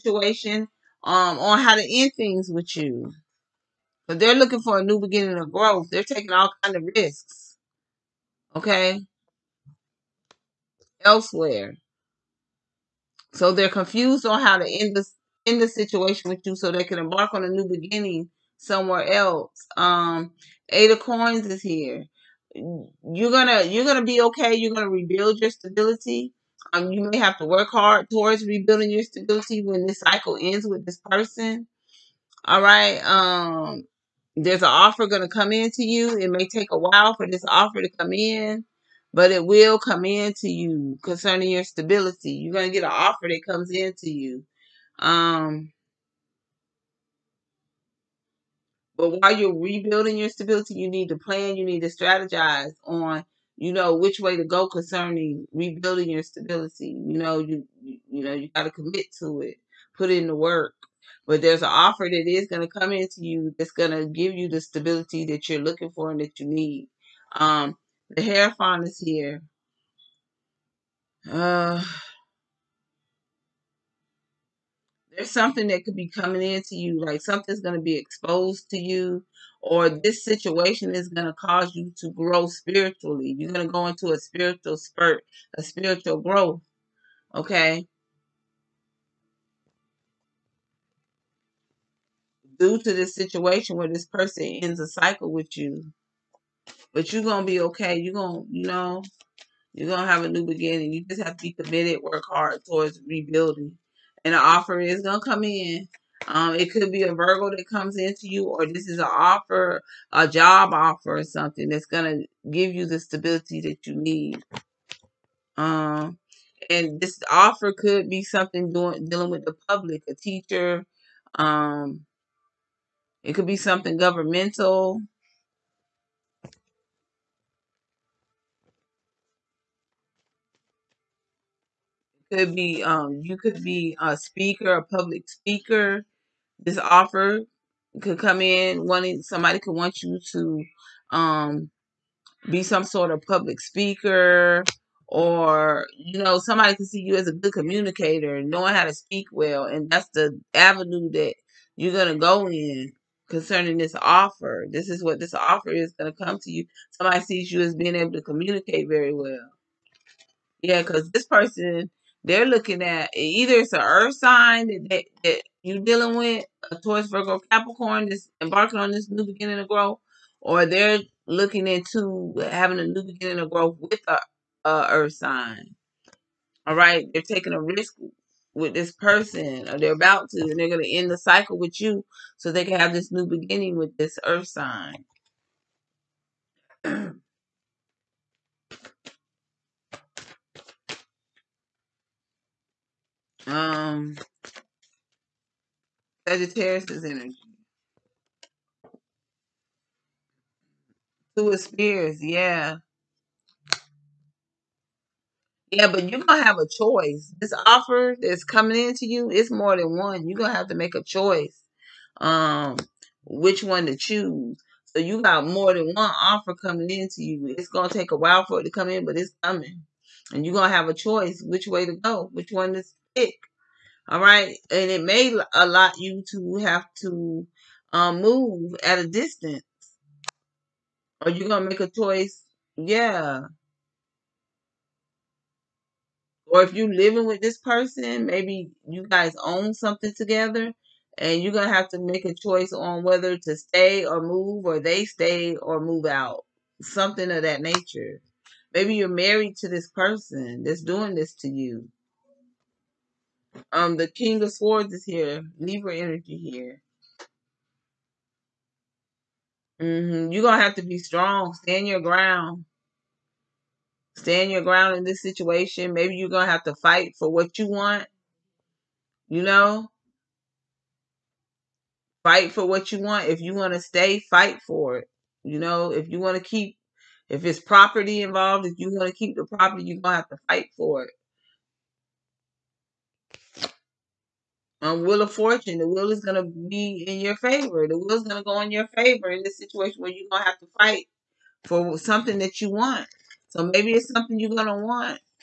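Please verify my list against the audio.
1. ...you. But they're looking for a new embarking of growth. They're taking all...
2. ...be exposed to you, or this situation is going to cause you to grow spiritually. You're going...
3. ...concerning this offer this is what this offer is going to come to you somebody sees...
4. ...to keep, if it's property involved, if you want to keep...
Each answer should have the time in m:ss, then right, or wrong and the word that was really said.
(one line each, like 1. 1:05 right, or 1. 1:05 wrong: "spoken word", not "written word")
1. 0:02 wrong: "beginning", not "embarking"
2. 1:17 right
3. 2:33 right
4. 4:36 right.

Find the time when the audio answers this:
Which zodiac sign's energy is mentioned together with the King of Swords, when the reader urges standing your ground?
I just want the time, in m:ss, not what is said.
4:15.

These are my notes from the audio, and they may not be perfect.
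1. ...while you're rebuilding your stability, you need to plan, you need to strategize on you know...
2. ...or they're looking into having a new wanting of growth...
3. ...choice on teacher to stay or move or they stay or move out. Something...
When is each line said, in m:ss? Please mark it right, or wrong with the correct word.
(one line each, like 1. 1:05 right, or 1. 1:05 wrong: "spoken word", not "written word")
1. 0:49 right
2. 2:50 wrong: "beginning", not "wanting"
3. 4:02 wrong: "whether", not "teacher".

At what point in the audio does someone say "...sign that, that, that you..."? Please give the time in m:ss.
2:44.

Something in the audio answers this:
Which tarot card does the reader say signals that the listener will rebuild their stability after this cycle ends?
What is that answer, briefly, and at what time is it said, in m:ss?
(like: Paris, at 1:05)
Eight of Coins, at 0:20.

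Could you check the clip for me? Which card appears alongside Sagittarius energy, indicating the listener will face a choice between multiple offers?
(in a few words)
Two of Spears.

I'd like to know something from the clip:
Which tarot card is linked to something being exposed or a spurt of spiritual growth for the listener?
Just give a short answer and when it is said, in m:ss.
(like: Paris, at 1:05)
The Hierophant, at 1:08.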